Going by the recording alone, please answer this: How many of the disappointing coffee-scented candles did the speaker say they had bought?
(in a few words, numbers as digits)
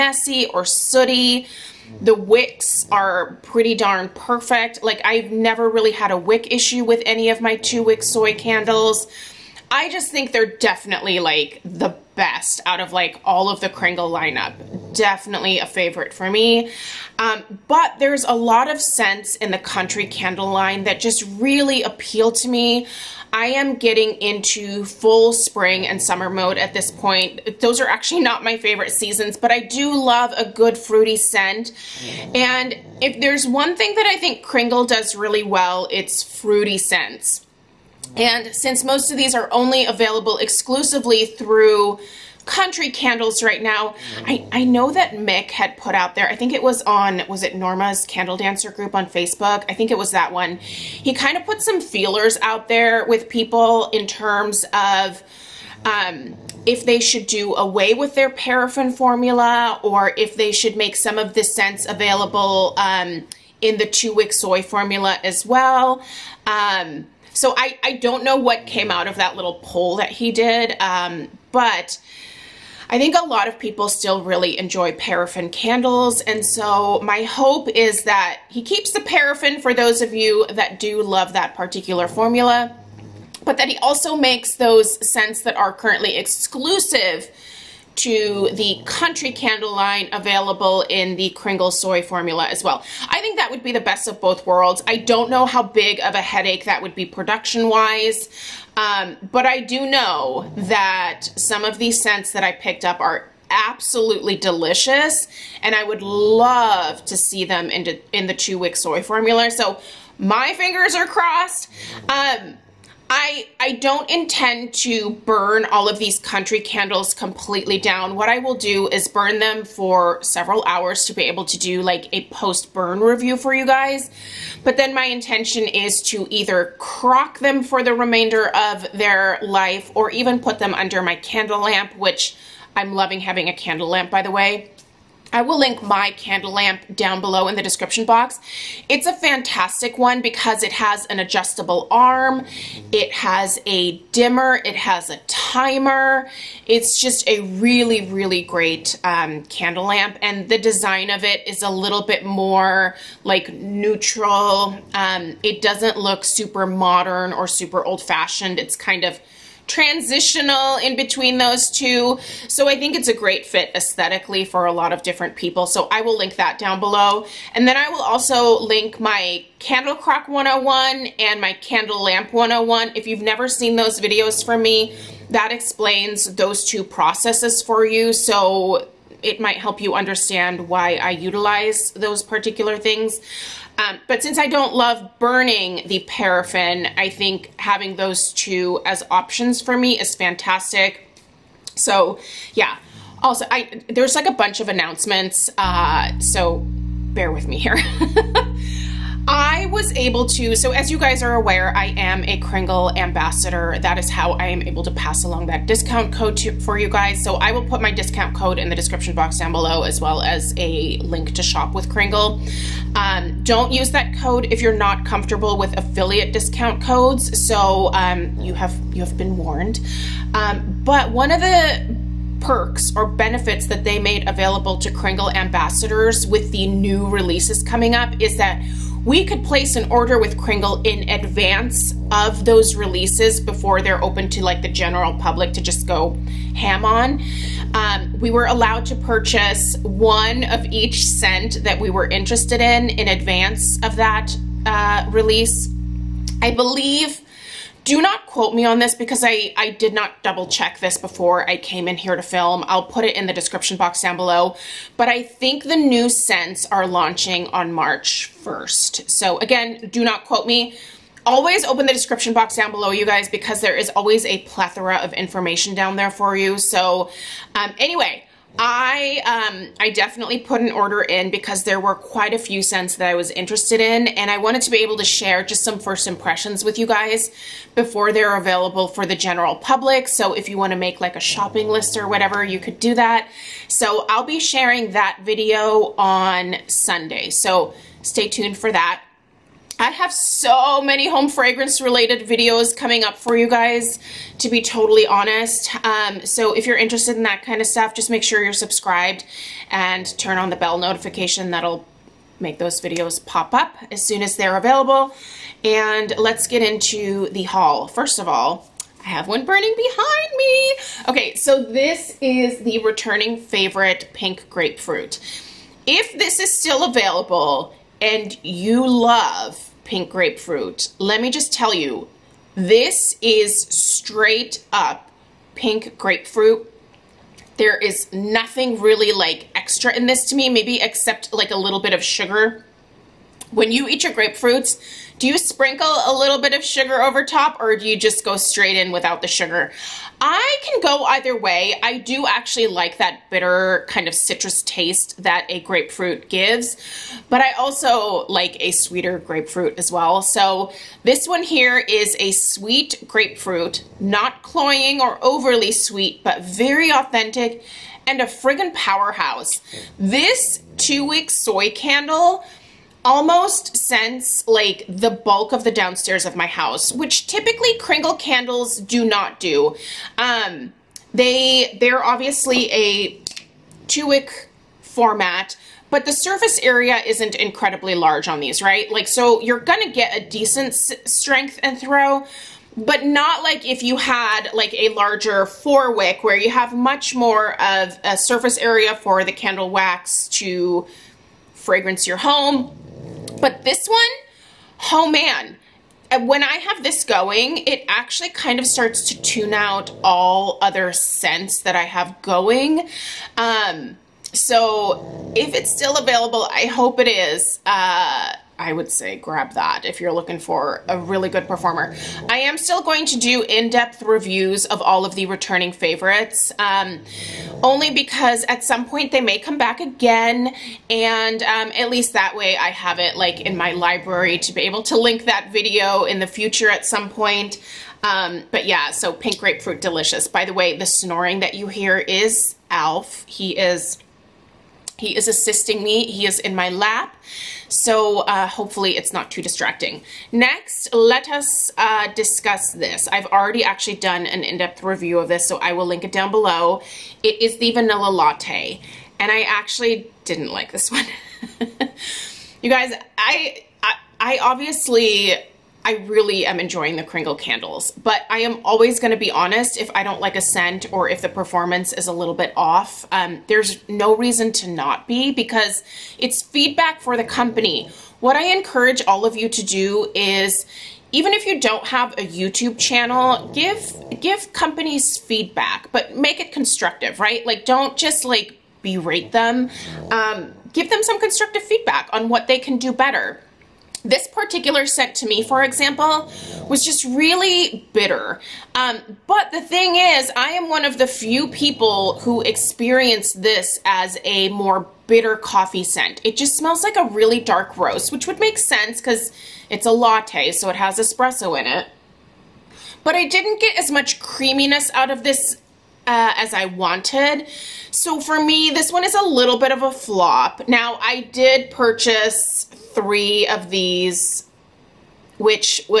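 3.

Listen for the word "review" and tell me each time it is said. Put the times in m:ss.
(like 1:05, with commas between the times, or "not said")
2:02, 6:54, 7:24.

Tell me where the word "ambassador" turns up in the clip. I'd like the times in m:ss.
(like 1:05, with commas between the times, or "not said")
3:22, 3:45.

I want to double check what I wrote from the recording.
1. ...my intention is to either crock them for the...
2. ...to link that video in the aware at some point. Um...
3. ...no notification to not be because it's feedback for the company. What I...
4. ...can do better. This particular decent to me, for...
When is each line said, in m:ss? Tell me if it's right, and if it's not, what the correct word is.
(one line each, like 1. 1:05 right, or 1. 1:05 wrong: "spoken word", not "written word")
1. 2:04 right
2. 7:04 wrong: "future", not "aware"
3. 7:43 wrong: "reason", not "notification"
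4. 8:02 wrong: "scent", not "decent".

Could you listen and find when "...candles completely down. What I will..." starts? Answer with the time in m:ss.
1:56.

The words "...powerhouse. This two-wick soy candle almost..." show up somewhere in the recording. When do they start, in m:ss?
5:58.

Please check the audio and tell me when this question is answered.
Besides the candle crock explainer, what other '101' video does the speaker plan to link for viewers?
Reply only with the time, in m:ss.
2:51.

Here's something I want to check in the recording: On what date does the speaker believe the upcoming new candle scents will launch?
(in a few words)
March 1.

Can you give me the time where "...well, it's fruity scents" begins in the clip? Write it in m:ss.
0:35.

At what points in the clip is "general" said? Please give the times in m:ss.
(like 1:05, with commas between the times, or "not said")
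3:54, 4:39.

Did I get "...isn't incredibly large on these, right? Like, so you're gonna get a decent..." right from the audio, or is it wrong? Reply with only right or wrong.
right.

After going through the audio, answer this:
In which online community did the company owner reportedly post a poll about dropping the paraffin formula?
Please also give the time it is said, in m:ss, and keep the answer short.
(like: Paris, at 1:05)
Norma's Candle Dancer group, at 0:47.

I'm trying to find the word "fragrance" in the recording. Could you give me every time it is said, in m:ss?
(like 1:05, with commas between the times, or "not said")
4:51, 6:31.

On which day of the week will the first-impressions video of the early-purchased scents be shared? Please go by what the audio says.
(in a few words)
Sunday.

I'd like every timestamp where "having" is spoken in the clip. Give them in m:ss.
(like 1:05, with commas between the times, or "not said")
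2:13, 3:07.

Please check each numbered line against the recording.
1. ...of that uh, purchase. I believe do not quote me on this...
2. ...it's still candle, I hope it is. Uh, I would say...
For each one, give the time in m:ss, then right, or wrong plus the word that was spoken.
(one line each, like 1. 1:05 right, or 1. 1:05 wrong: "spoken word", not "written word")
1. 4:03 wrong: "release", not "purchase"
2. 6:45 wrong: "available", not "candle".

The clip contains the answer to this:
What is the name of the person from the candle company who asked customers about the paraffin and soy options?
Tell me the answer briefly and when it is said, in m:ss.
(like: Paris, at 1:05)
Mick, at 0:45.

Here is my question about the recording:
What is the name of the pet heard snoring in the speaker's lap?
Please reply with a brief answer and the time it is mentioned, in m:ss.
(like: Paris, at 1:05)
Alf, at 7:12.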